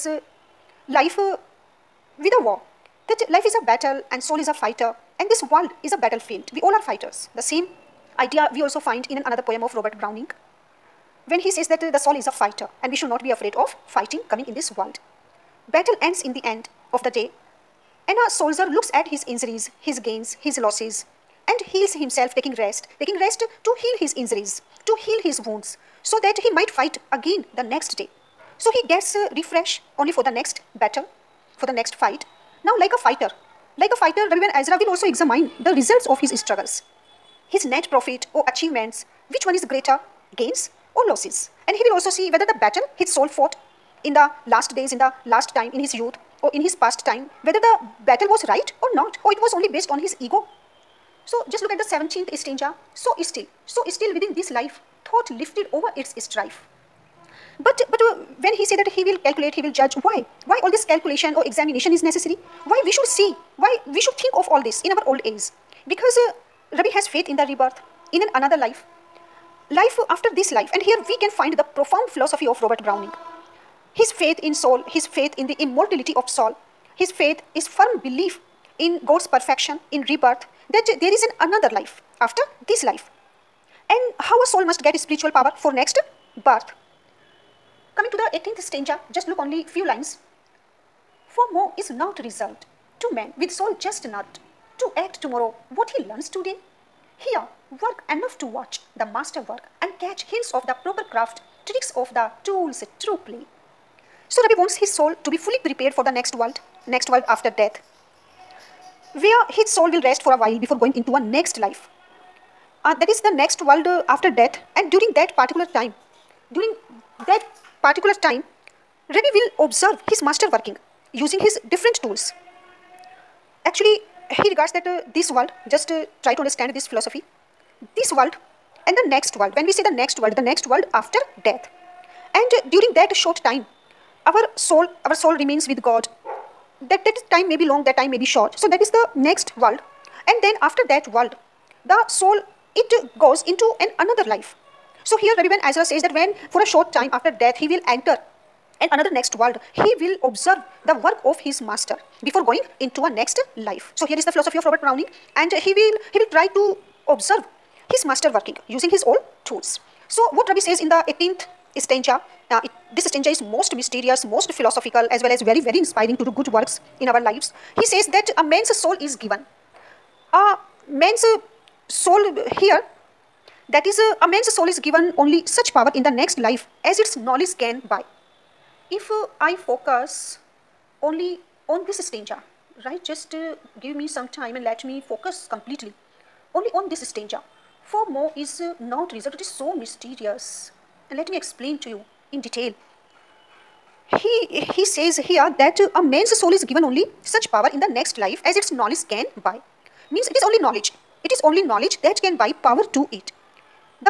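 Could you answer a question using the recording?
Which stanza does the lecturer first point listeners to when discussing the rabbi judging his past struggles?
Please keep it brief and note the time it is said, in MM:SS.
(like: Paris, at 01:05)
17th, at 00:51.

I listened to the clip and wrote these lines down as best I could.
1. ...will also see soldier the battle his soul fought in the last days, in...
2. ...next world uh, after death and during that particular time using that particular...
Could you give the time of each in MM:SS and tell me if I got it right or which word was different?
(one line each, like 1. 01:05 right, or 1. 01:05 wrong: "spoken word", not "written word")
1. 00:41 wrong: "whether", not "soldier"
2. 01:53 wrong: "during", not "using".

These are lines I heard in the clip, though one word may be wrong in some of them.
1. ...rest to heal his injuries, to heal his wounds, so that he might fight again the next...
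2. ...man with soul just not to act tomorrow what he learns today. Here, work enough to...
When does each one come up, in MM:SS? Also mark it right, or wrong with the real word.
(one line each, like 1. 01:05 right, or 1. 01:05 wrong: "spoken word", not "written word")
1. 00:23 right
2. 01:33 right.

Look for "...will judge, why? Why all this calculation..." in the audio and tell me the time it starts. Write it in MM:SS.
00:59.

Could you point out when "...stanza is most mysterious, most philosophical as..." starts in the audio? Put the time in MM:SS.
02:43.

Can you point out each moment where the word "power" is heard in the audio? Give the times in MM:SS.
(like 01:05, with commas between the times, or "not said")
01:25, 02:55, 03:17, 03:22.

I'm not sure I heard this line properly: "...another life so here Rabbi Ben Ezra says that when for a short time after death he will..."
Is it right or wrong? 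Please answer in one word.
right.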